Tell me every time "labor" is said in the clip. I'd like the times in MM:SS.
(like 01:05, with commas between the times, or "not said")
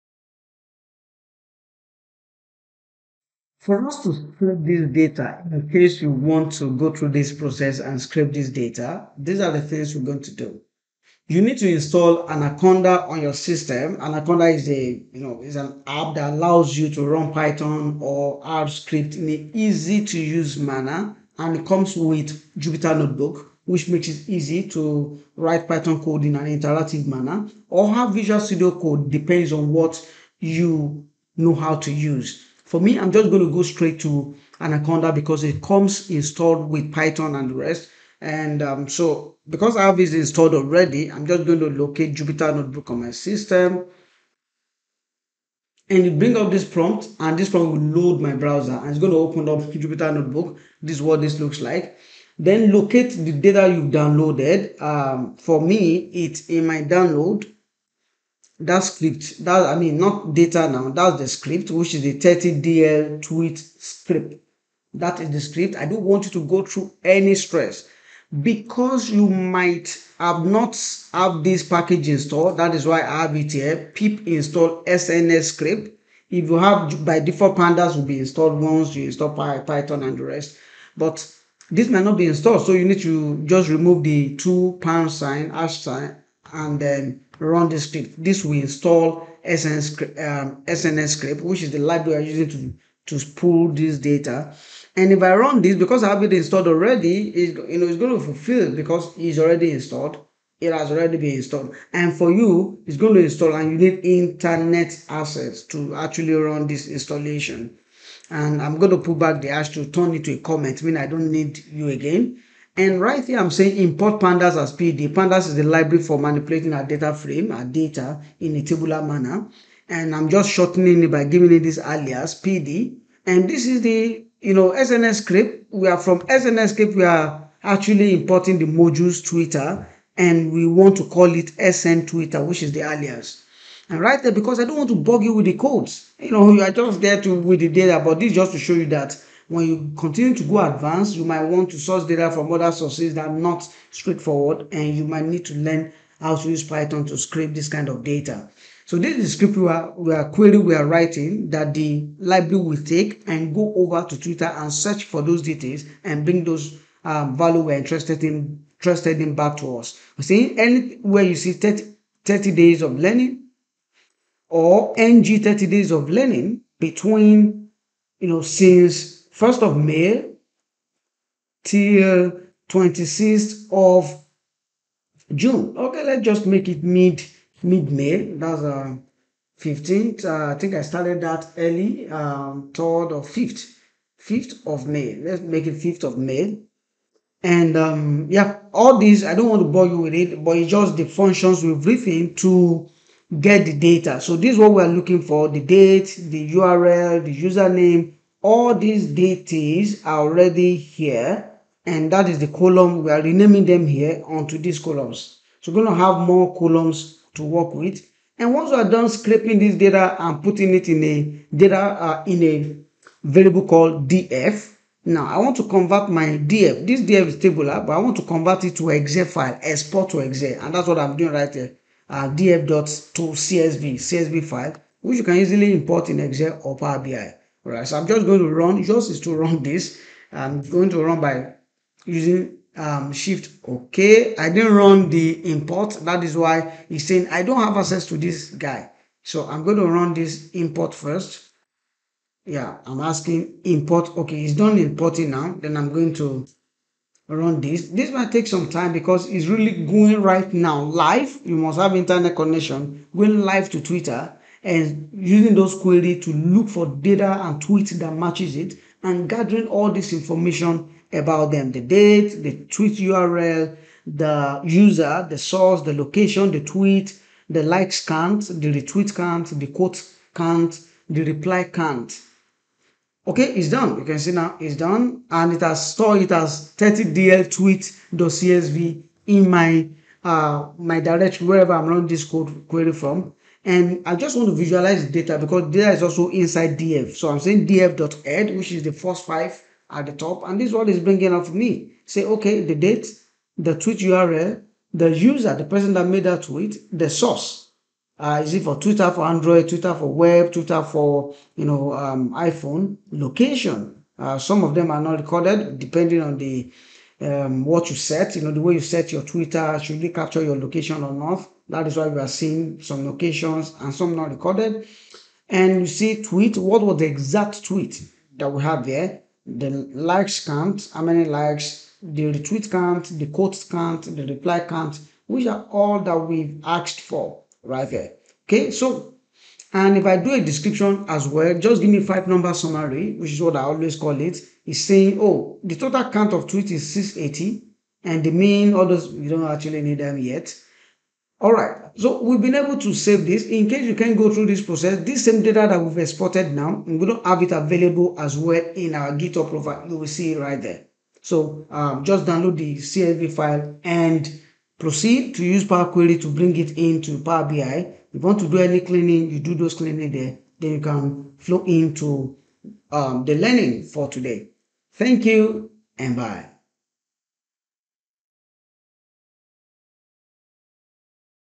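not said.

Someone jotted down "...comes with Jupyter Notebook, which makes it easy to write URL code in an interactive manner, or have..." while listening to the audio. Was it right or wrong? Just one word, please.
wrong.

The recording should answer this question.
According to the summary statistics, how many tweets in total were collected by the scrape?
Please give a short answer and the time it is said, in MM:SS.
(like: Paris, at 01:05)
680, at 05:36.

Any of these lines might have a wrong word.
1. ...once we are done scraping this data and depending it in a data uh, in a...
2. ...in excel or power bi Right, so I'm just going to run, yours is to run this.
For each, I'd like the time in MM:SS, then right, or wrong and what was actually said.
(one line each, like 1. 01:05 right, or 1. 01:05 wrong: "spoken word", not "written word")
1. 03:28 wrong: "putting", not "depending"
2. 03:46 right.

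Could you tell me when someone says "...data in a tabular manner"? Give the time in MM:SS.
01:57.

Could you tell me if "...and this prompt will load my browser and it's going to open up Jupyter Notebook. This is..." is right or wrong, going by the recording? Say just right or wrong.
right.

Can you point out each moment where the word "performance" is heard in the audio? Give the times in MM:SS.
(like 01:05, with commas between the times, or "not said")
not said.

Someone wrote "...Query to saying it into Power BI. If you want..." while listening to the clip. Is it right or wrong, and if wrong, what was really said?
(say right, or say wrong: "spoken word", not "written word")
wrong: "bring", not "saying".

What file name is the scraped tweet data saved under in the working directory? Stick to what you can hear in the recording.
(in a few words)
30dl tweet.csv.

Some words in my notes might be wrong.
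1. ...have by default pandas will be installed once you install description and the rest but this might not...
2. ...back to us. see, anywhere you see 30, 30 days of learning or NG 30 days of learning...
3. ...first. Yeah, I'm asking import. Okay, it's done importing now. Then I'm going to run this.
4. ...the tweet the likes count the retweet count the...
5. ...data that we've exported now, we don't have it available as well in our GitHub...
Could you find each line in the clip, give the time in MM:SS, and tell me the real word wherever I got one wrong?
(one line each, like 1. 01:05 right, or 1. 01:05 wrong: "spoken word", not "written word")
1. 01:16 wrong: "python", not "description"
2. 02:39 right
3. 04:00 right
4. 04:26 right
5. 05:45 right.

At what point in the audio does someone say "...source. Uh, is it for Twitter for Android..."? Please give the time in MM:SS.
04:57.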